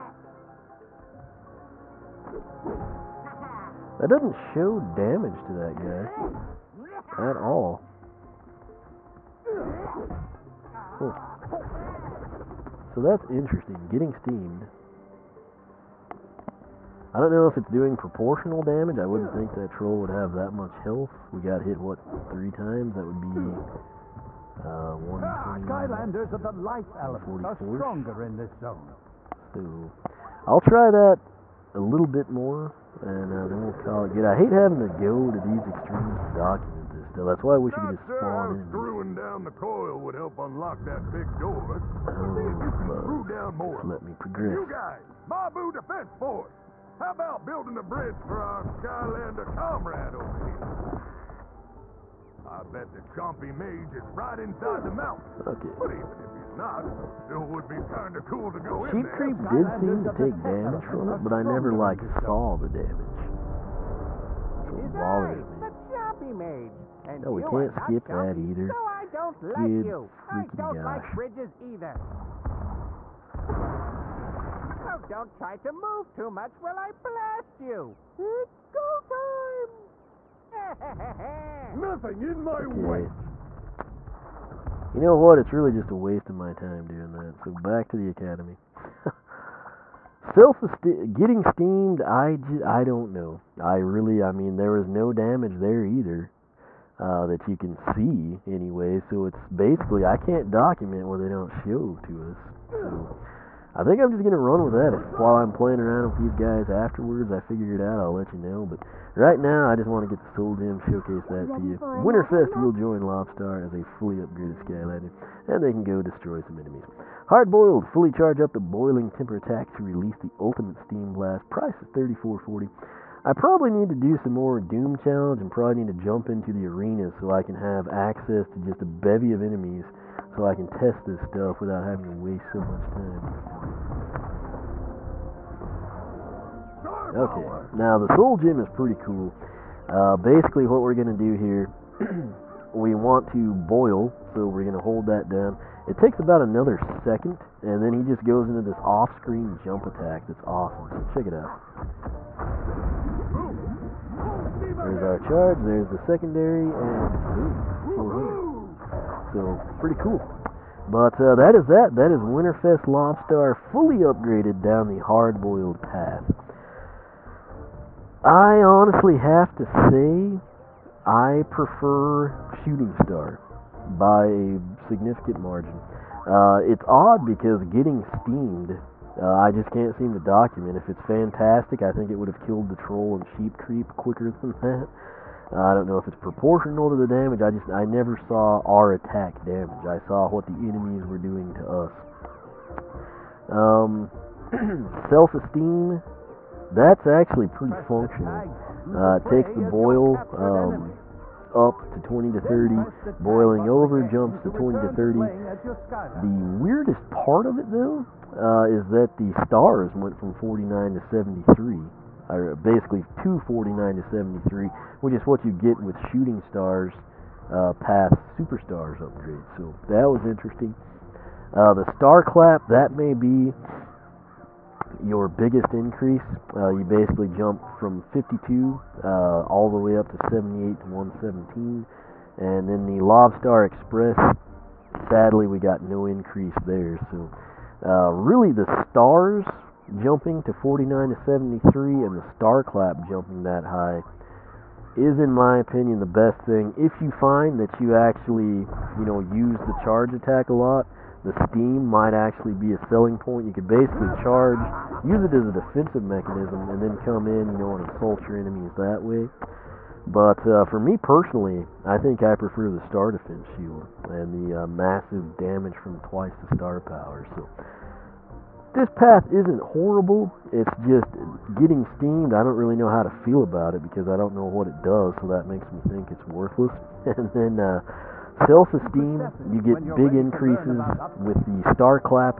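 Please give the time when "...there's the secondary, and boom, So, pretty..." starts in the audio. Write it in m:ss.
2:35.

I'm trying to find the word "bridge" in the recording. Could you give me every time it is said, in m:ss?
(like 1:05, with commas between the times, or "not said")
0:47, 1:11.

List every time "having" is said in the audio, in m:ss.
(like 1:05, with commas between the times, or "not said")
0:34, 2:11.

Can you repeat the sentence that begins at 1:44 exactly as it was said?
If while I'm playing around with these guys afterwards, I figure it out, I'll let you know.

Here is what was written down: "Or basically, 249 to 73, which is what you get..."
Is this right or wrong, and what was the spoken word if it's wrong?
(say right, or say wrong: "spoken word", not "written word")
right.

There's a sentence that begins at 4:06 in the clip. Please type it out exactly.
If you find that you actually, you know, use the charge attack a lot, the steam might actually be a selling point.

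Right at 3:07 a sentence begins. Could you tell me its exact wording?
I just I never saw our attack damage.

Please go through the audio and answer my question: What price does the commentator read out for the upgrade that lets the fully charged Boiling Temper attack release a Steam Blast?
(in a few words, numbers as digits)
34.40.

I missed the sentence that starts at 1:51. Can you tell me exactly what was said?
Winterfest will join Lob-Star as a fully upgraded Skylander, and they can go destroy some enemies.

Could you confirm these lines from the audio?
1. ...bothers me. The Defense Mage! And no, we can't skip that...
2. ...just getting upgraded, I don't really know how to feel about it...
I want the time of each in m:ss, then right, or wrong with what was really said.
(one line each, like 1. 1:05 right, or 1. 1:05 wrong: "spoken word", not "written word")
1. 1:04 wrong: "Chompy", not "Defense"
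2. 4:30 wrong: "steamed", not "upgraded".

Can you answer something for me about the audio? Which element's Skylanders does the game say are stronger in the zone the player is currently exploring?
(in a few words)
Life.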